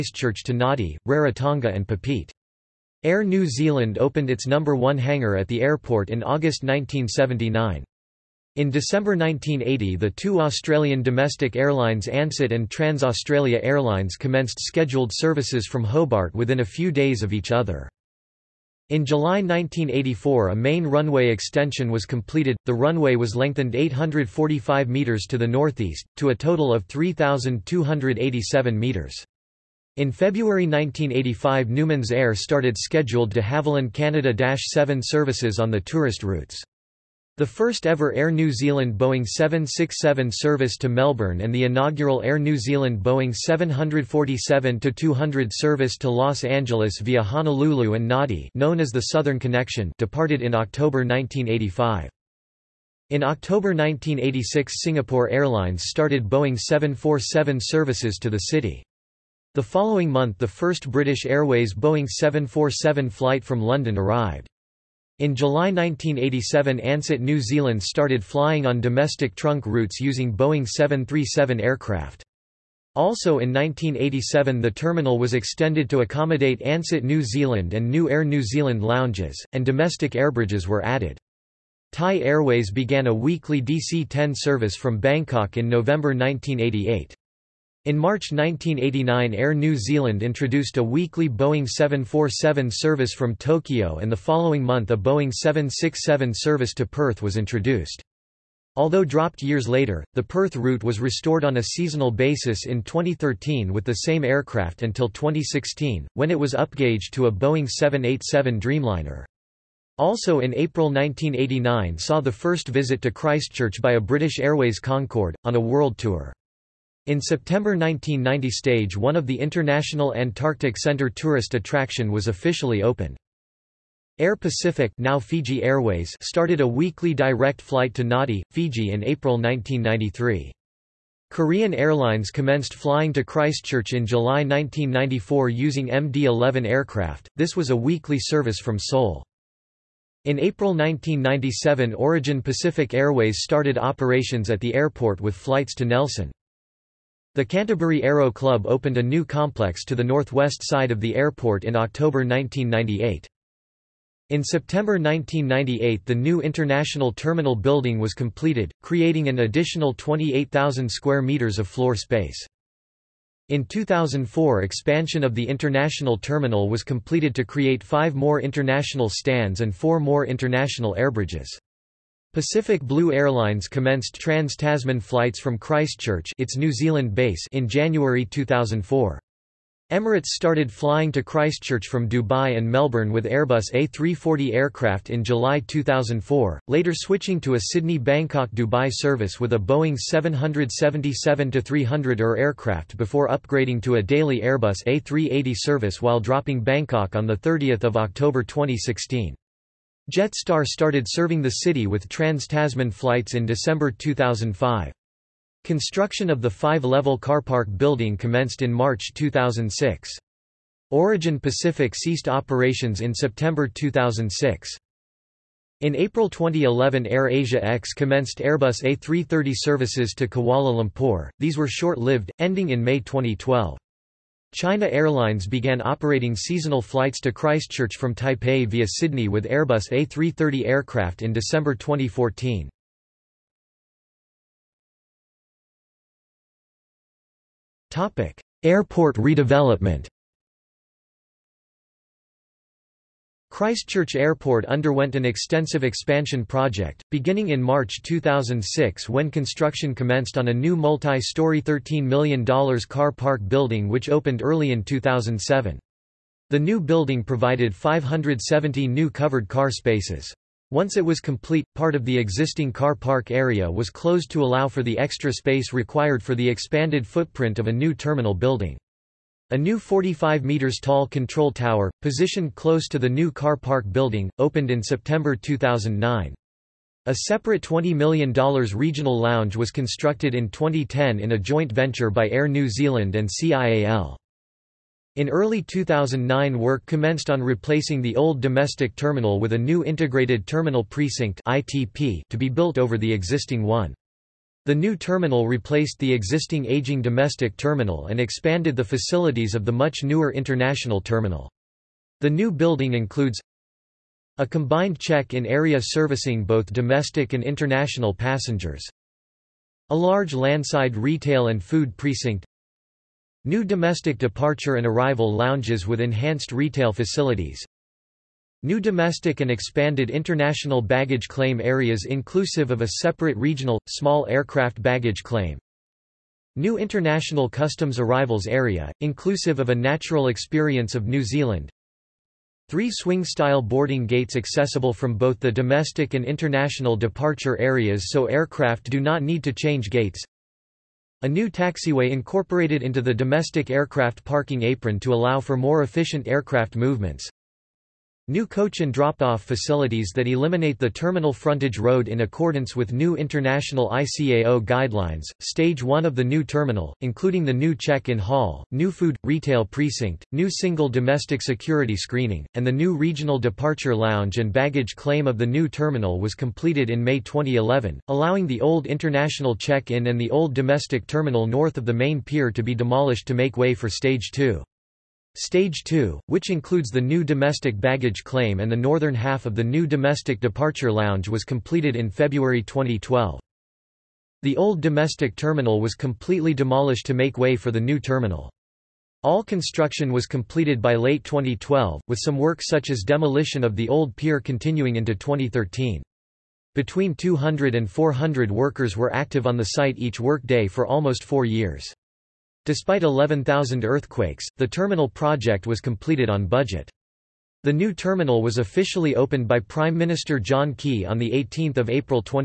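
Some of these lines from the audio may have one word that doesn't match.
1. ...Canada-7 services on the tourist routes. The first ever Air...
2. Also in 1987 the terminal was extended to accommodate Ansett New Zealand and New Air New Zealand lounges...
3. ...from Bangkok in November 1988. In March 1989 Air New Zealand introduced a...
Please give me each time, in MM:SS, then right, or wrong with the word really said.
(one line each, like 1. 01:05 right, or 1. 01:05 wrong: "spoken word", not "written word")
1. 00:33 right
2. 01:12 right
3. 01:24 right.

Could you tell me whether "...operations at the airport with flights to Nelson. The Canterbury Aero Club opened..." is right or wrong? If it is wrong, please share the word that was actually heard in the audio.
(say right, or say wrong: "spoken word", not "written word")
right.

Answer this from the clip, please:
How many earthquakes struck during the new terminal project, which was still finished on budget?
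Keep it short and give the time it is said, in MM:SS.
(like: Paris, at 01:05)
11,000, at 06:43.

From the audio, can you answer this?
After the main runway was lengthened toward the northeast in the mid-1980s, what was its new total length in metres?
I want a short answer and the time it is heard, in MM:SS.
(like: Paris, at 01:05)
3,287 metres, at 00:26.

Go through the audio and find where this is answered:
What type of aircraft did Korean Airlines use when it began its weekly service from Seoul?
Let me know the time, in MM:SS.
02:15.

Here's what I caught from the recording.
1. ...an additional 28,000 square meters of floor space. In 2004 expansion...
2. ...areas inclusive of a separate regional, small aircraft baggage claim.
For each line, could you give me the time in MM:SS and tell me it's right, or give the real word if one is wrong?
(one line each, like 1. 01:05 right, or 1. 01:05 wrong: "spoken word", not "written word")
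1. 02:39 right
2. 05:21 right.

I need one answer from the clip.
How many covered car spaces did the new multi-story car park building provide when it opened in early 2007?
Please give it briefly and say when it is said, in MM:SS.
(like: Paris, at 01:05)
570, at 04:17.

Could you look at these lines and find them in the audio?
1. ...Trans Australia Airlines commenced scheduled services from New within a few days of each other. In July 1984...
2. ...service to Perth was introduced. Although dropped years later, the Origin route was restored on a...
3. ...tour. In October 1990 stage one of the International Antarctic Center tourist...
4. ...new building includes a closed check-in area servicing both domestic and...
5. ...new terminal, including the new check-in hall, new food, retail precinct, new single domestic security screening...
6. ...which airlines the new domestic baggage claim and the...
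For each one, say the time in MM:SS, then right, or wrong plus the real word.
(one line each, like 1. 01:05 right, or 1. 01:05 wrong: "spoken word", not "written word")
1. 00:12 wrong: "Hobart", not "New"
2. 01:36 wrong: "Perth", not "Origin"
3. 01:55 wrong: "September", not "October"
4. 05:02 wrong: "combined", not "closed"
5. 05:56 right
6. 06:16 wrong: "includes", not "airlines".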